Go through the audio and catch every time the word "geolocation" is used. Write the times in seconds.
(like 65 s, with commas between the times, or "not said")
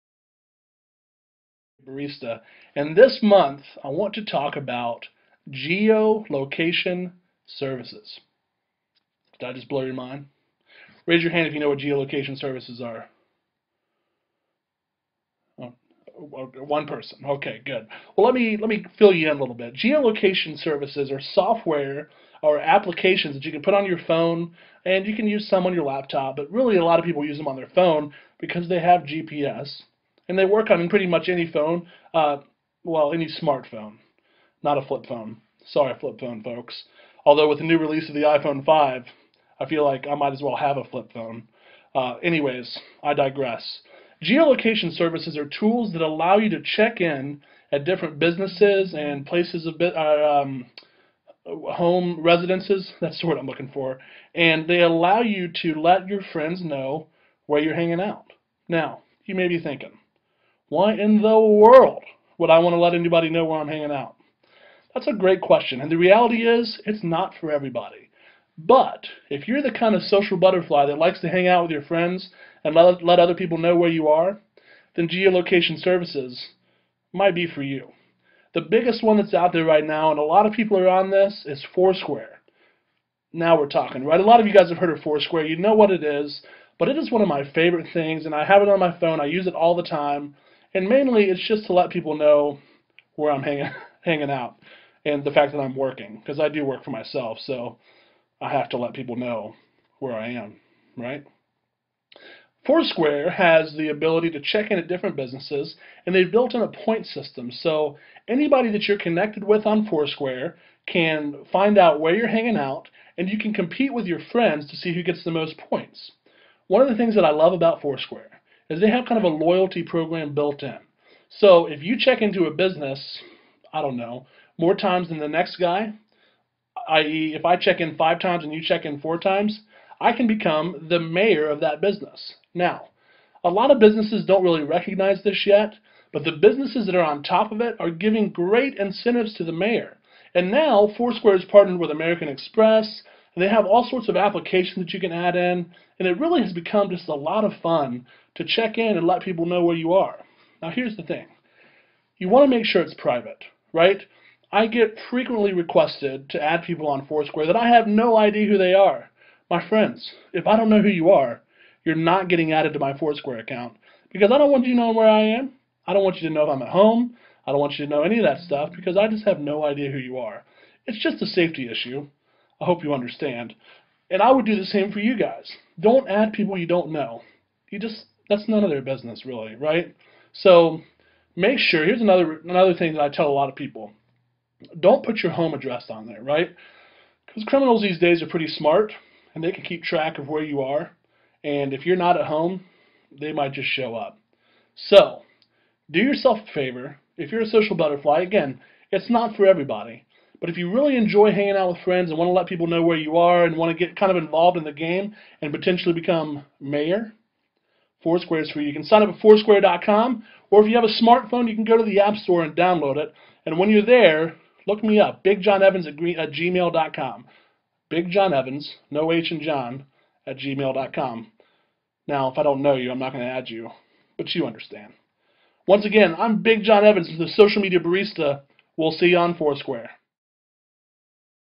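5 s, 11 s, 19 s, 44 s, 75 s.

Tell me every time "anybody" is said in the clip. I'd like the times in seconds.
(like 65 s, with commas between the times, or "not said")
62 s, 108 s.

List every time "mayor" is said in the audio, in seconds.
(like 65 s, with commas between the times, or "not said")
130 s, 139 s, 206 s.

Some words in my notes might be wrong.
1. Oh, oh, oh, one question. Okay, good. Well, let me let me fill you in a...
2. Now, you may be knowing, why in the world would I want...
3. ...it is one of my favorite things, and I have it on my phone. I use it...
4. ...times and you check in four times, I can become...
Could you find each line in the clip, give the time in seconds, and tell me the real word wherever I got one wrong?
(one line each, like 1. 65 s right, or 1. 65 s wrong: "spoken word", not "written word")
1. 15 s wrong: "person", not "question"
2. 58 s wrong: "thinking", not "knowing"
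3. 86 s right
4. 128 s right.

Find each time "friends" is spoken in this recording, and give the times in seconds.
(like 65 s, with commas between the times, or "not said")
56 s, 71 s, 114 s, 159 s, 201 s.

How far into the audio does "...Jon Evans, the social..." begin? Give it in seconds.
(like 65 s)
226 s.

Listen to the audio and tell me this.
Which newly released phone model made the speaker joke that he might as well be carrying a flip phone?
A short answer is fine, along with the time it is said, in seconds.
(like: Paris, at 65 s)
iPhone 5, at 38 s.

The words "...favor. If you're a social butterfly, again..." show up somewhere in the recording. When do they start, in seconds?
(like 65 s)
196 s.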